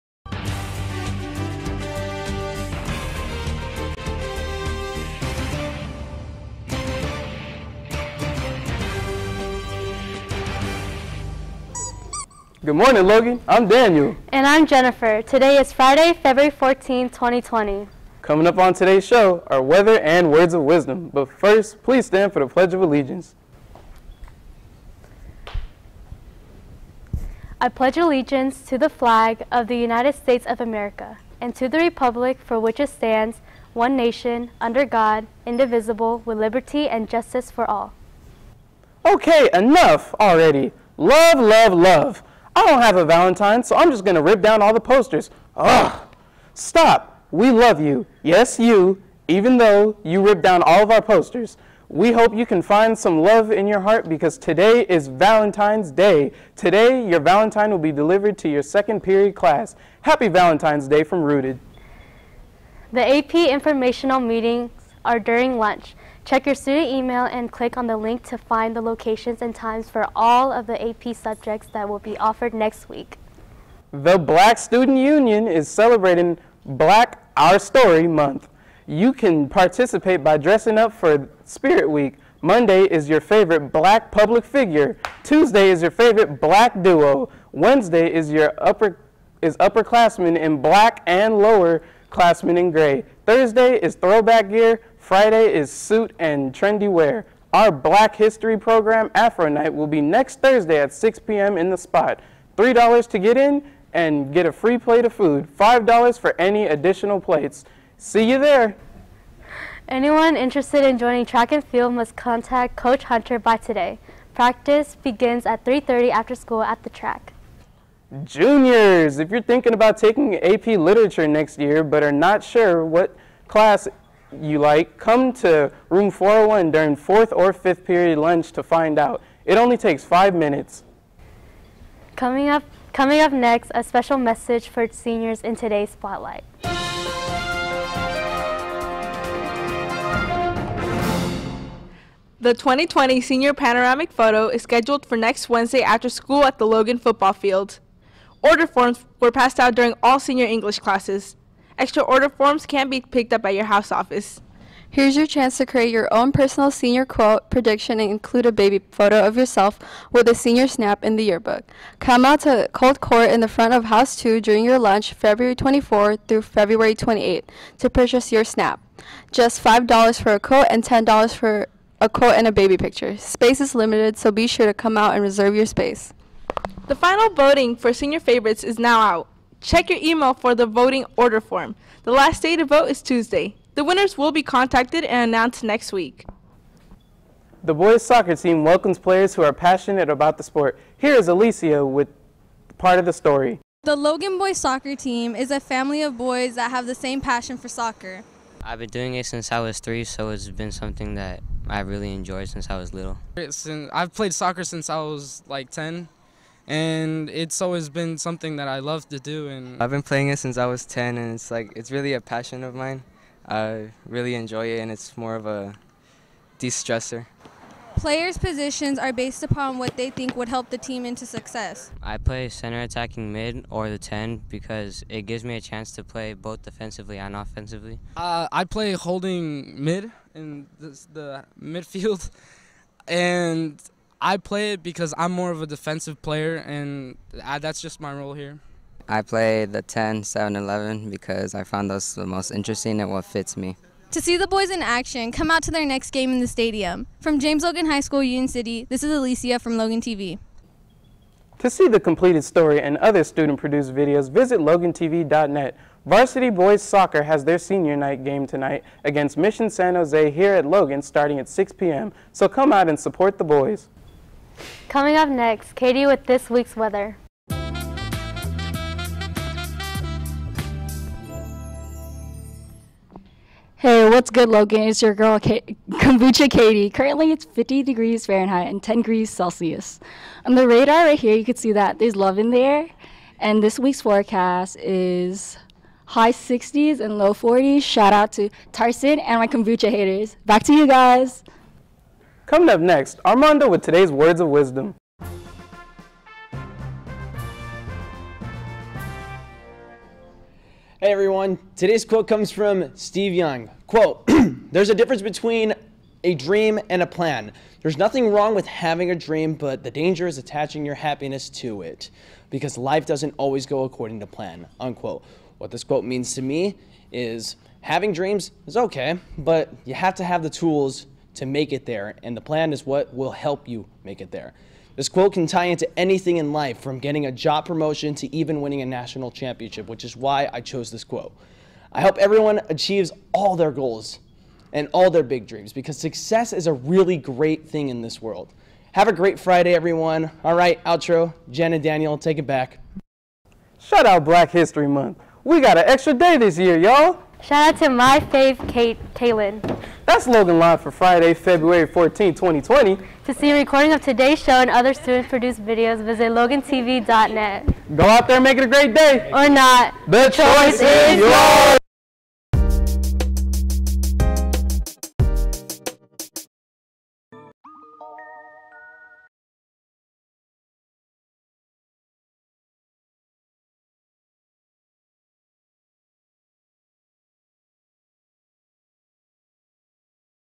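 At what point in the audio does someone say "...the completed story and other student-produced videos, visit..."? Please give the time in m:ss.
4:11.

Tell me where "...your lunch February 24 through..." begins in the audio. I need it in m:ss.
2:44.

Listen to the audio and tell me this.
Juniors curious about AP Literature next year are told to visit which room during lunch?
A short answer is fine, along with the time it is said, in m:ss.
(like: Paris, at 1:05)
Room 401, at 2:05.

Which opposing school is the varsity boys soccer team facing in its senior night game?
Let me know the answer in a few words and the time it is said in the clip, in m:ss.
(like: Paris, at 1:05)
Mission San Jose, at 4:19.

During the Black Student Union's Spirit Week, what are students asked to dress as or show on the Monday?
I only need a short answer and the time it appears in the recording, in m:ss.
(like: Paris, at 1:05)
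Favorite black public figure, at 1:23.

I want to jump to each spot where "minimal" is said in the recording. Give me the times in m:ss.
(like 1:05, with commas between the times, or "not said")
not said.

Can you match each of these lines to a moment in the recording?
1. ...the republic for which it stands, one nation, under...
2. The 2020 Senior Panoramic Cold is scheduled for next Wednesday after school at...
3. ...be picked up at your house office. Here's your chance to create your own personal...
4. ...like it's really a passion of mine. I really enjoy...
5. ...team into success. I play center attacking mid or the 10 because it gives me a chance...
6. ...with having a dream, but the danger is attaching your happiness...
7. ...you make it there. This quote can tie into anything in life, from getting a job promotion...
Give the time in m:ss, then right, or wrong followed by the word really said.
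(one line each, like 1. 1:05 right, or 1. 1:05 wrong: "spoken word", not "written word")
1. 0:31 right
2. 2:22 wrong: "Photo", not "Cold"
3. 2:32 right
4. 3:31 right
5. 3:40 right
6. 5:08 right
7. 5:23 right.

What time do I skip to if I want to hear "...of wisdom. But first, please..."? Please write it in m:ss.
0:20.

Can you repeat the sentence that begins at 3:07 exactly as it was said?
The boys soccer team welcomes players who are passionate about the sport.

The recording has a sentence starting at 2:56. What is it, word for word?
The final voting for senior favorites is now out.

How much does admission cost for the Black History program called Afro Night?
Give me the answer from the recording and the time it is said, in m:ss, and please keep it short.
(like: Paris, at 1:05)
$3, at 1:42.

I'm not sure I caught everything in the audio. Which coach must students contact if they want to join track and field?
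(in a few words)
Coach Hunter.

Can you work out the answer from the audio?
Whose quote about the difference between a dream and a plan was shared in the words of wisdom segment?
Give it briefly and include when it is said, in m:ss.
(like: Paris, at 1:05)
Steve Young, at 5:02.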